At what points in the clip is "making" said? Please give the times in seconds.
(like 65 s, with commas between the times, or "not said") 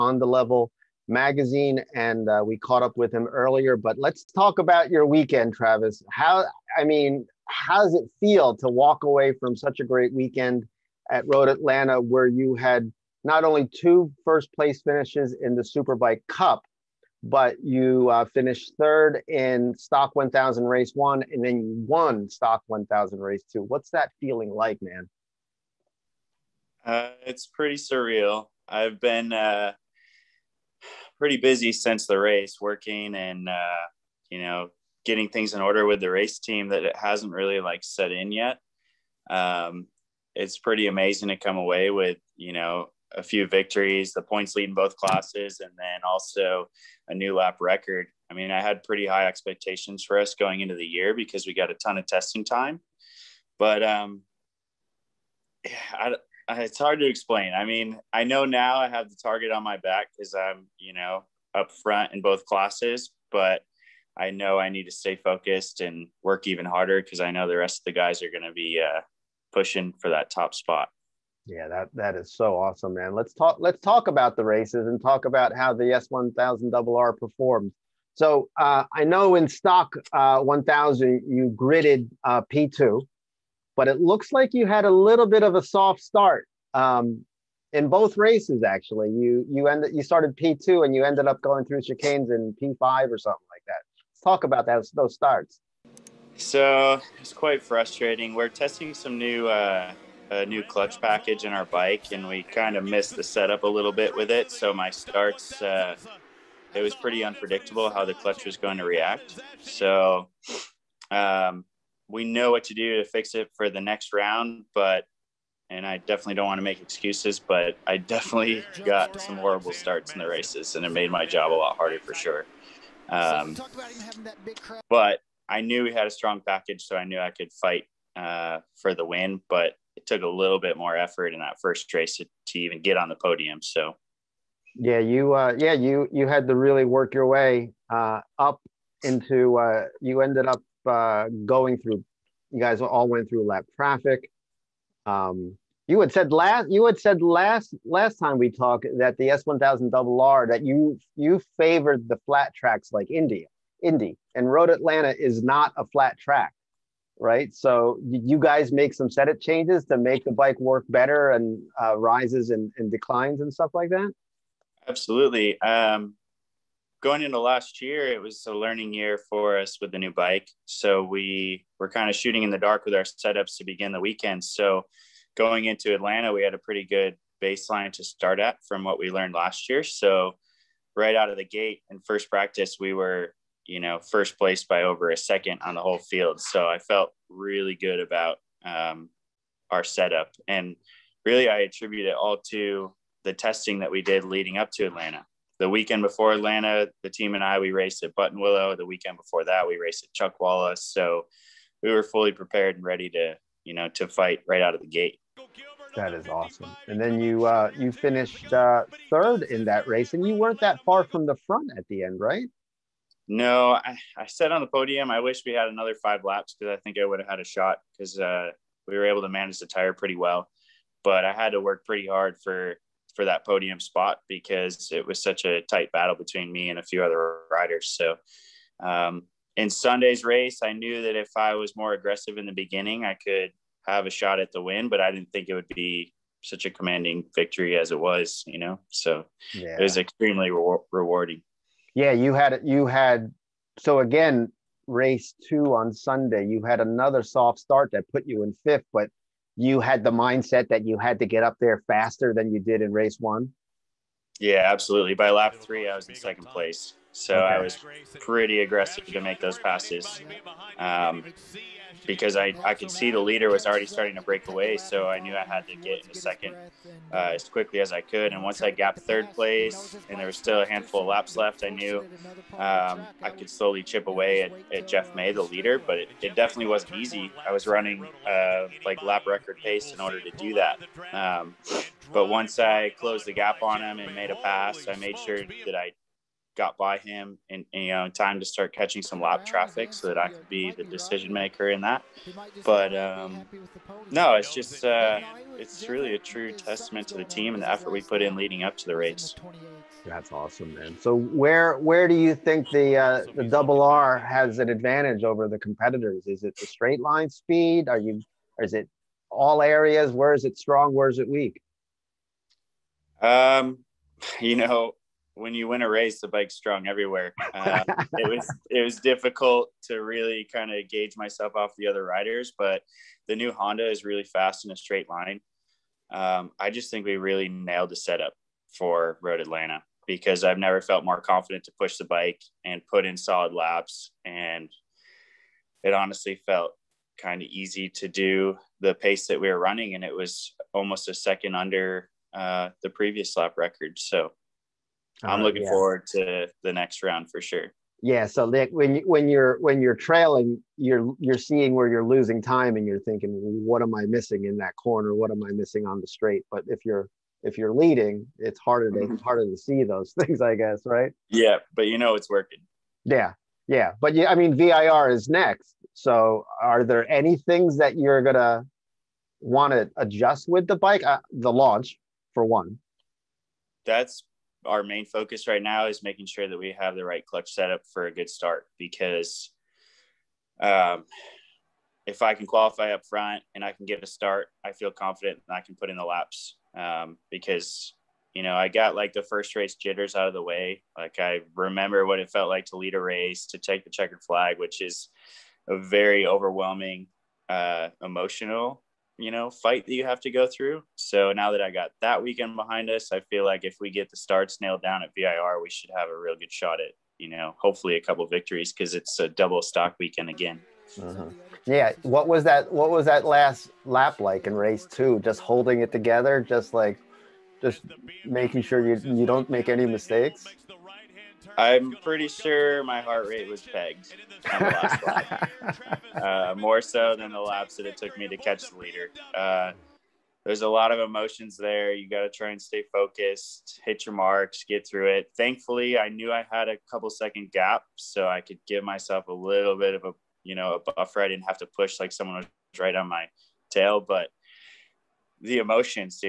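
376 s, 418 s.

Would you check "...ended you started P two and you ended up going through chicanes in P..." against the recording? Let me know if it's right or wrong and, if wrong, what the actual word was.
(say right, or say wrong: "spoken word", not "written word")
right.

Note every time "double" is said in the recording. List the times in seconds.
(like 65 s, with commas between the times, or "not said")
76 s, 149 s, 303 s, 409 s.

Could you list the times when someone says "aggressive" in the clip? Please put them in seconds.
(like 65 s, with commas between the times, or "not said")
231 s, 258 s.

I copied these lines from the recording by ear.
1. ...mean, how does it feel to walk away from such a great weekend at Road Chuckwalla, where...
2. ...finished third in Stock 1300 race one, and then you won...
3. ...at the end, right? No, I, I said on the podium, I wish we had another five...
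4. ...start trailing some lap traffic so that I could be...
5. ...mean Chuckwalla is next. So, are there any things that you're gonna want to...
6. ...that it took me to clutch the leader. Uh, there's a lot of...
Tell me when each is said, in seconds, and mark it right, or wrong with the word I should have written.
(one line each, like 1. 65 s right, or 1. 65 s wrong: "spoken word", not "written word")
1. 6 s wrong: "Atlanta", not "Chuckwalla"
2. 18 s wrong: "1000", not "1300"
3. 211 s right
4. 288 s wrong: "catching", not "trailing"
5. 364 s wrong: "VIR", not "Chuckwalla"
6. 427 s wrong: "catch", not "clutch".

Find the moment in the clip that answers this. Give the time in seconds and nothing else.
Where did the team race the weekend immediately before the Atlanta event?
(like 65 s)
198 s.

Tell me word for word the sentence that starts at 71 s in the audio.
Yeah, that that is so awesome, man.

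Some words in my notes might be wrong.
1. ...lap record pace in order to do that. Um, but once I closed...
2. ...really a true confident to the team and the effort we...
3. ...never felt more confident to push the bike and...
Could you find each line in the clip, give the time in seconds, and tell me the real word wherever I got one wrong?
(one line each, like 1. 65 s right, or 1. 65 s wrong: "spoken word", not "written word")
1. 279 s right
2. 295 s wrong: "testament", not "confident"
3. 330 s right.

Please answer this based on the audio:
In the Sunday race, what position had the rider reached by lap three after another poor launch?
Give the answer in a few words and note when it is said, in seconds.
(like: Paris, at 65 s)
second place, at 256 s.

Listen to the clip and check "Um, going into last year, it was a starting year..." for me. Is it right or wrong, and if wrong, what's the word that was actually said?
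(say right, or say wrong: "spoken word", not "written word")
wrong: "learning", not "starting".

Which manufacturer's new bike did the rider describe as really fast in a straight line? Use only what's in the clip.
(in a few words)
Honda.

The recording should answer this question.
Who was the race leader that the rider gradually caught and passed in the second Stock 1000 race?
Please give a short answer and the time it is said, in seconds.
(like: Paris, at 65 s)
Jeff May, at 274 s.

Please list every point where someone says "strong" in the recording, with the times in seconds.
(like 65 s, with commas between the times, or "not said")
126 s, 310 s, 316 s.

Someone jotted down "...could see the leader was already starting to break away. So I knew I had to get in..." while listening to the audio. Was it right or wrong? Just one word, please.
right.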